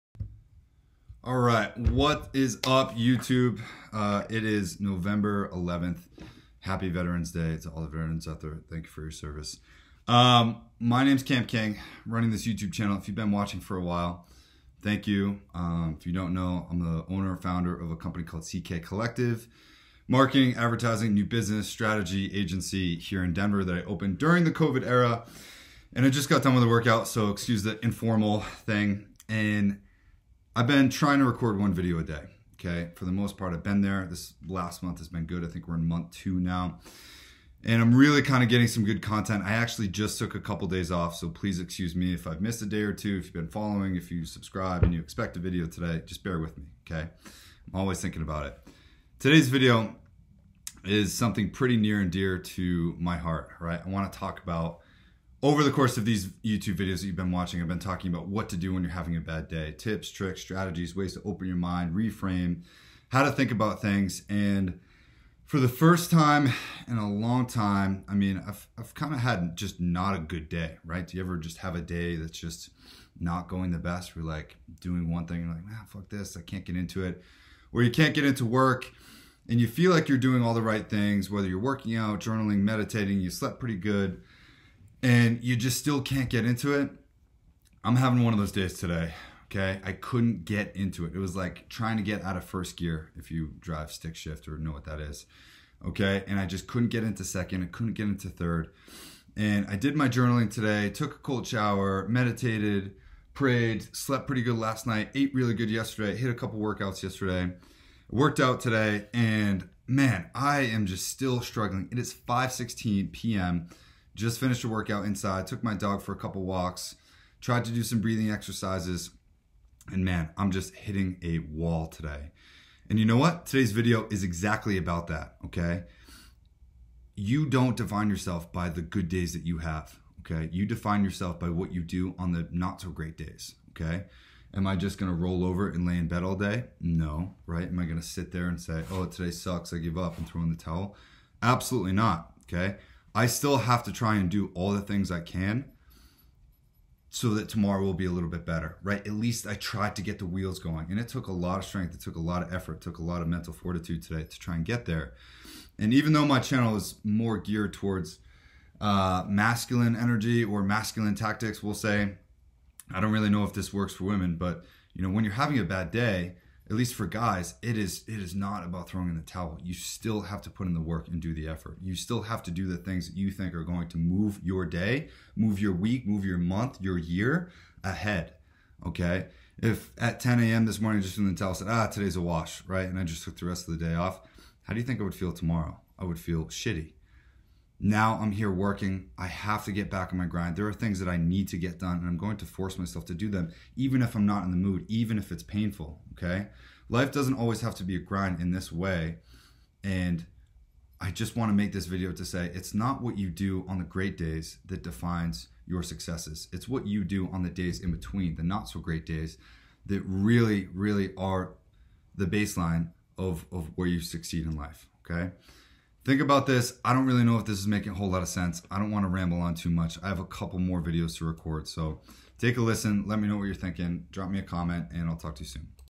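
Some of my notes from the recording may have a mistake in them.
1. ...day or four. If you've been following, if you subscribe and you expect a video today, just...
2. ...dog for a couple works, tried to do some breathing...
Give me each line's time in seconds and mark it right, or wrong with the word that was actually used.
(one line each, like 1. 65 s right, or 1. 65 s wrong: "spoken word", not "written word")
1. 42 s wrong: "two", not "four"
2. 115 s wrong: "walks", not "works".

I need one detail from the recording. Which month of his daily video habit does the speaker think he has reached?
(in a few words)
Month two.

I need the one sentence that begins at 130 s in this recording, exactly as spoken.
You define yourself by what you do on the not so great days, okay?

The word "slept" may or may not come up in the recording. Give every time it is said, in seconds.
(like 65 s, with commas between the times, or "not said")
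83 s, 103 s.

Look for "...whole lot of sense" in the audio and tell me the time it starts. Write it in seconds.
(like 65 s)
217 s.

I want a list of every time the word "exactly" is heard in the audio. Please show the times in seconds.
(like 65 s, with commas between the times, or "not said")
124 s.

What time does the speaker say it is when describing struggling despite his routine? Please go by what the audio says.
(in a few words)
5:16 p.m.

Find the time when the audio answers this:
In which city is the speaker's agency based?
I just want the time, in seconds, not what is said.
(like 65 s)
23 s.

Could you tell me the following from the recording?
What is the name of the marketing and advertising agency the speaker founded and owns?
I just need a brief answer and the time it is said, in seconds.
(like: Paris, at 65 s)
CK Collective, at 18 s.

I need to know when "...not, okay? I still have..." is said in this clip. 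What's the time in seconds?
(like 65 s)
141 s.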